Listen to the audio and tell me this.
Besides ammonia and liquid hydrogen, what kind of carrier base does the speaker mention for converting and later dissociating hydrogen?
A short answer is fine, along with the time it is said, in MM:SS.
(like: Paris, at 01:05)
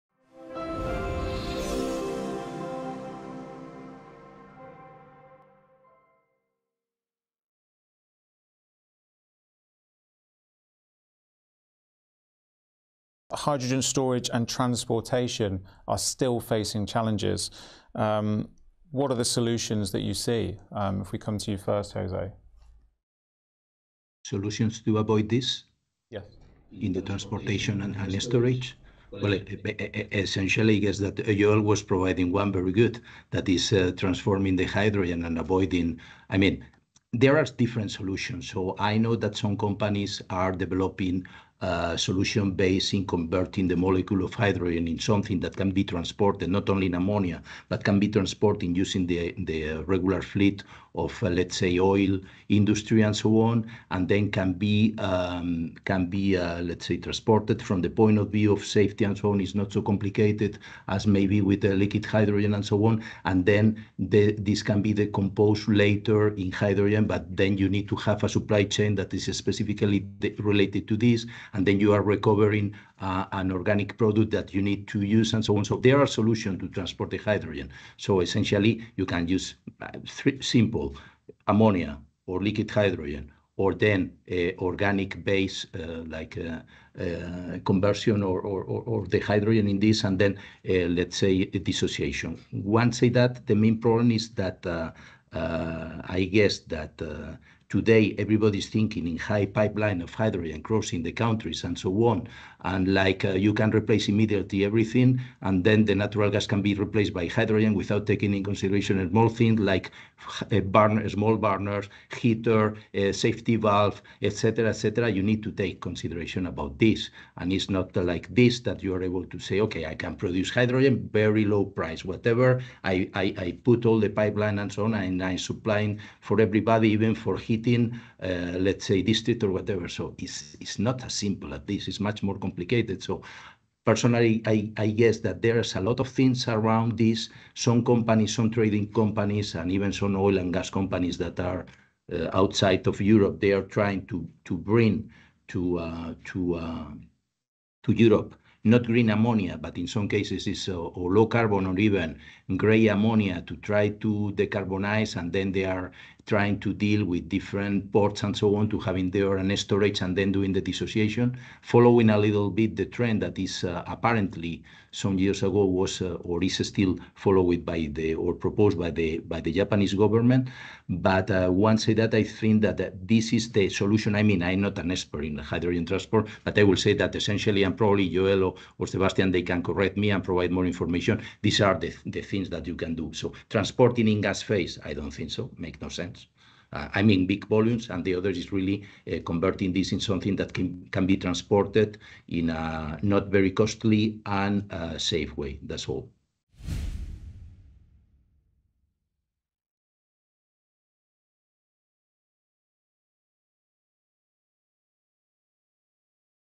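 organic base, at 01:24.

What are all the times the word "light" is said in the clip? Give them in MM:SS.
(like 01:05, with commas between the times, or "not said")
not said.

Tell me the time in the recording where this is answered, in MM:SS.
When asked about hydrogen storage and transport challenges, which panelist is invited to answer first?
00:21.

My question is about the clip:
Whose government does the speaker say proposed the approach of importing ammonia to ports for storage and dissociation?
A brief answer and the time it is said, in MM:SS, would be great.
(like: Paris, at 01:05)
Japanese government, at 02:49.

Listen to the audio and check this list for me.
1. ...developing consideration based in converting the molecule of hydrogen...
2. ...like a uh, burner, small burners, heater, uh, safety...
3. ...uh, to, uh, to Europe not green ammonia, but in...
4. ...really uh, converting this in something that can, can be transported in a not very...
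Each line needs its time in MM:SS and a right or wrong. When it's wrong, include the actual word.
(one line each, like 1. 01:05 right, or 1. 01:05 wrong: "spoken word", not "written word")
1. 00:40 wrong: "solution", not "consideration"
2. 01:49 right
3. 02:25 right
4. 03:08 right.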